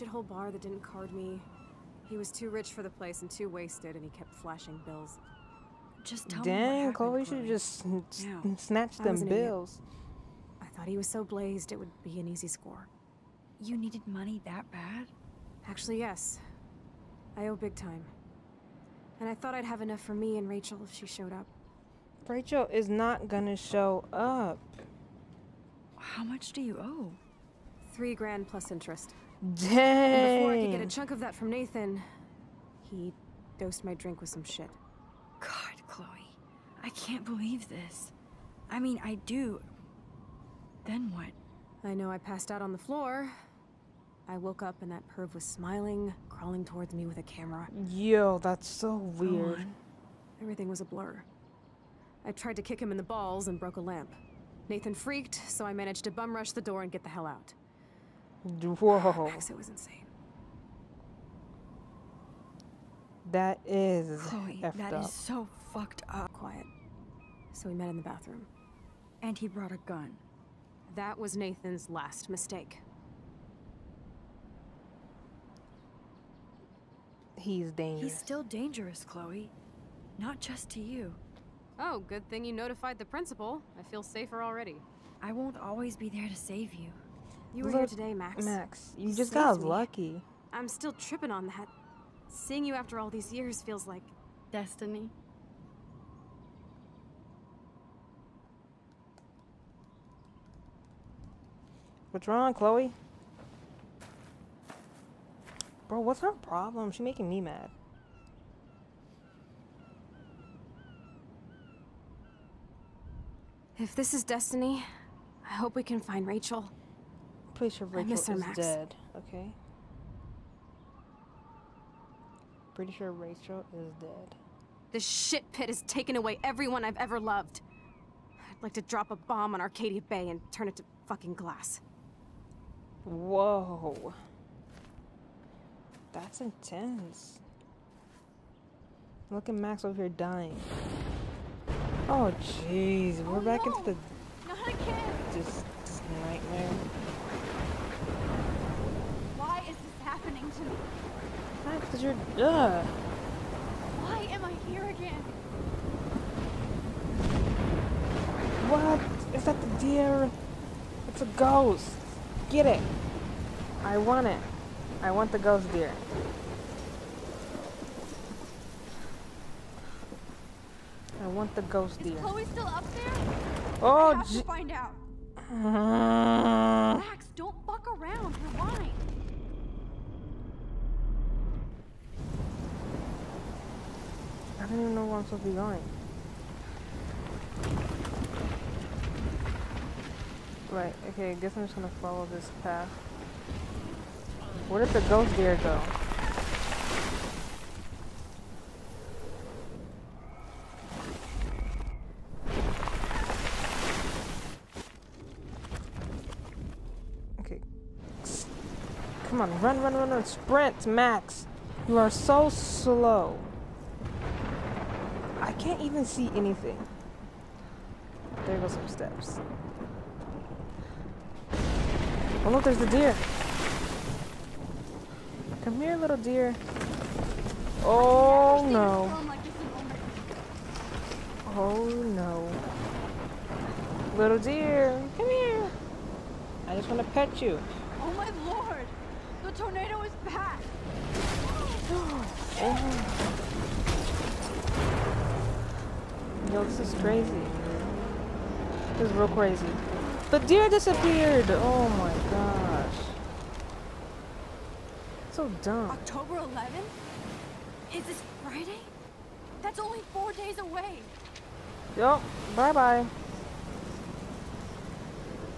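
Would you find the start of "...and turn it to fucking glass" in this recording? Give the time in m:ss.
2:10.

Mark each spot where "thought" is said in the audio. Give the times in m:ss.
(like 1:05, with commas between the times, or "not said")
0:10, 0:19.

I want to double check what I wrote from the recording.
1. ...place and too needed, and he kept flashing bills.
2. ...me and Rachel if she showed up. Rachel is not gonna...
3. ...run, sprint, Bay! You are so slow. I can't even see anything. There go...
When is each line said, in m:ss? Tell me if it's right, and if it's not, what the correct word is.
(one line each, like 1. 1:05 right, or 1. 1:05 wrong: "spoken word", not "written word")
1. 0:02 wrong: "wasted", not "needed"
2. 0:20 right
3. 3:30 wrong: "Max", not "Bay".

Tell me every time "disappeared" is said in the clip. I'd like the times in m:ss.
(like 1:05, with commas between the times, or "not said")
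4:10.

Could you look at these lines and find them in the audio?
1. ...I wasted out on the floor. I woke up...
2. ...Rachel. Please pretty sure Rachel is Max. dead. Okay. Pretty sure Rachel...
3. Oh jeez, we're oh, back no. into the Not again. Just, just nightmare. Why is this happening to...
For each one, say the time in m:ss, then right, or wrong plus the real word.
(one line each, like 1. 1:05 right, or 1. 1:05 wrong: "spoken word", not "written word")
1. 0:42 wrong: "passed", not "wasted"
2. 1:56 right
3. 2:22 right.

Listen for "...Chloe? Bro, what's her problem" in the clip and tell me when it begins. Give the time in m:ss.
1:42.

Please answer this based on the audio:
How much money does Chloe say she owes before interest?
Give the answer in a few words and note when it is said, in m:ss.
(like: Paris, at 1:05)
3 grand, at 0:27.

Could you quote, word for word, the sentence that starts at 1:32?
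Seeing you after all these years feels like...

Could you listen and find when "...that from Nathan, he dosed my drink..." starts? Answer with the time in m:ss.
0:31.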